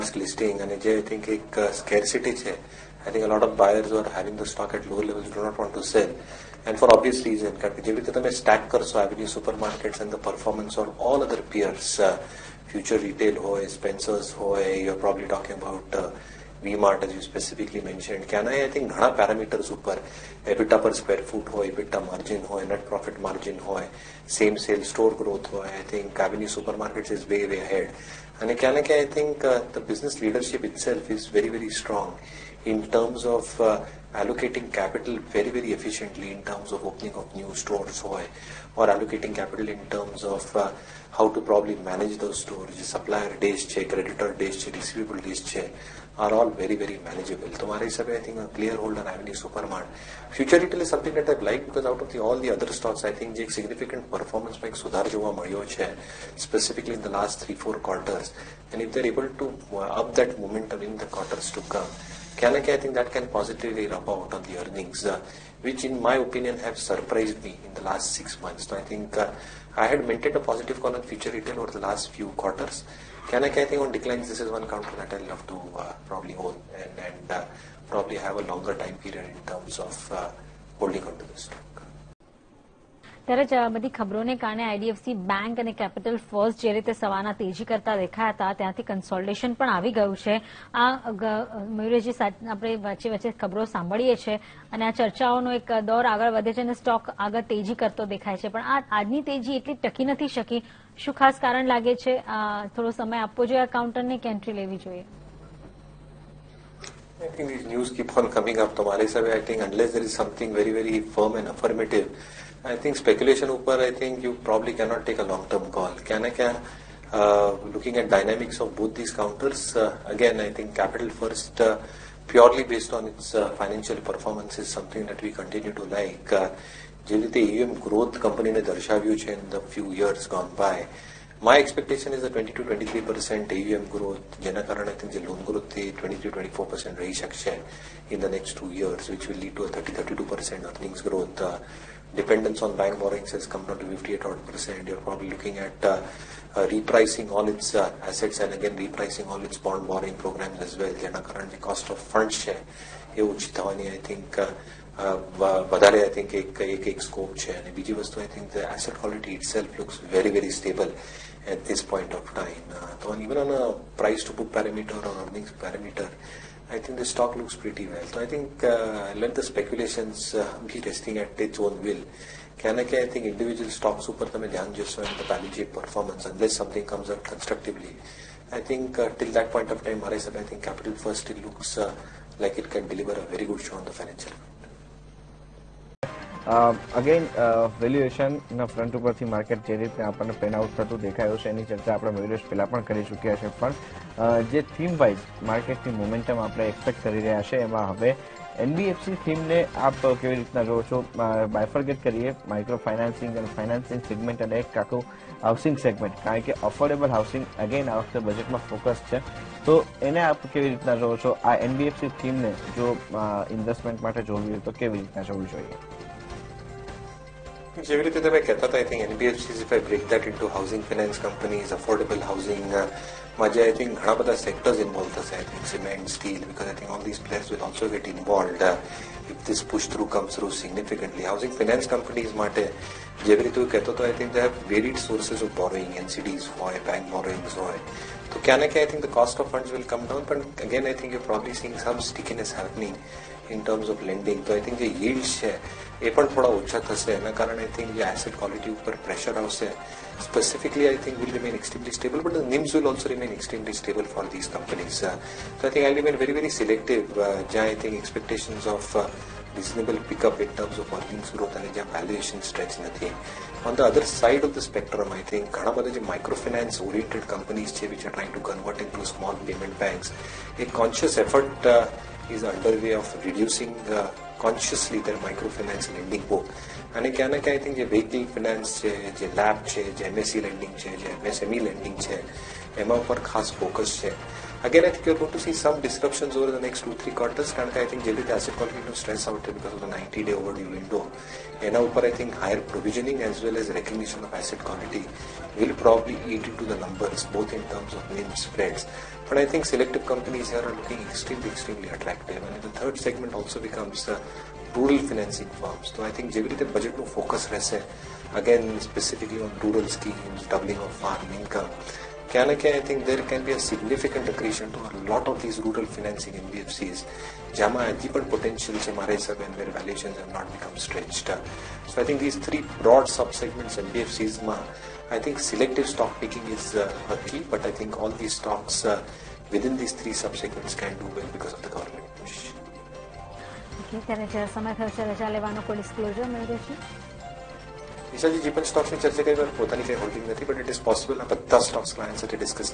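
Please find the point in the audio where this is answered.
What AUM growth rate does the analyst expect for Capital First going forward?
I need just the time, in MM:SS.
02:12.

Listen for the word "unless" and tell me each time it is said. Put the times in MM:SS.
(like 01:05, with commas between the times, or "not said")
01:49, 02:56.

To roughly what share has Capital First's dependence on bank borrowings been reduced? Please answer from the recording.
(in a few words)
58 percent.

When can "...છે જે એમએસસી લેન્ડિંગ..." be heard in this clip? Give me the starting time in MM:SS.
04:39.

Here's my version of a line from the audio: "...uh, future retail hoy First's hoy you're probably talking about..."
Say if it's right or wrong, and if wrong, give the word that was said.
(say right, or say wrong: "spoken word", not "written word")
wrong: "Spencer", not "First".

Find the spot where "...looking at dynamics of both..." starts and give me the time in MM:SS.
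01:57.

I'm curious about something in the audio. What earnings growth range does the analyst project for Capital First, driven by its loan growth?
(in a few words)
30-32%.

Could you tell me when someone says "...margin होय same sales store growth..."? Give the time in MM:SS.
00:23.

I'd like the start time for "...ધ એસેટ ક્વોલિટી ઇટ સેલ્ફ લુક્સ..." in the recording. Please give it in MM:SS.
02:38.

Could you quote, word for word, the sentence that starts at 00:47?
Tomorrow is, I think, a clear hold on Avenue Supermart.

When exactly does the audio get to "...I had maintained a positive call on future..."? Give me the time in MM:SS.
01:09.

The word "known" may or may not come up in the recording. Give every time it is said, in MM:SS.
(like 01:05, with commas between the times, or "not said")
not said.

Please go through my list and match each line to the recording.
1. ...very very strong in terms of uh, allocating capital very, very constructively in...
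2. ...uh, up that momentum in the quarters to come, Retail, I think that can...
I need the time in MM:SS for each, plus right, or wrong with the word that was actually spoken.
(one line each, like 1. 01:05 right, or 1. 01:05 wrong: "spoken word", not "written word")
1. 00:31 wrong: "efficiently", not "constructively"
2. 00:59 wrong: "Kalaki", not "Retail".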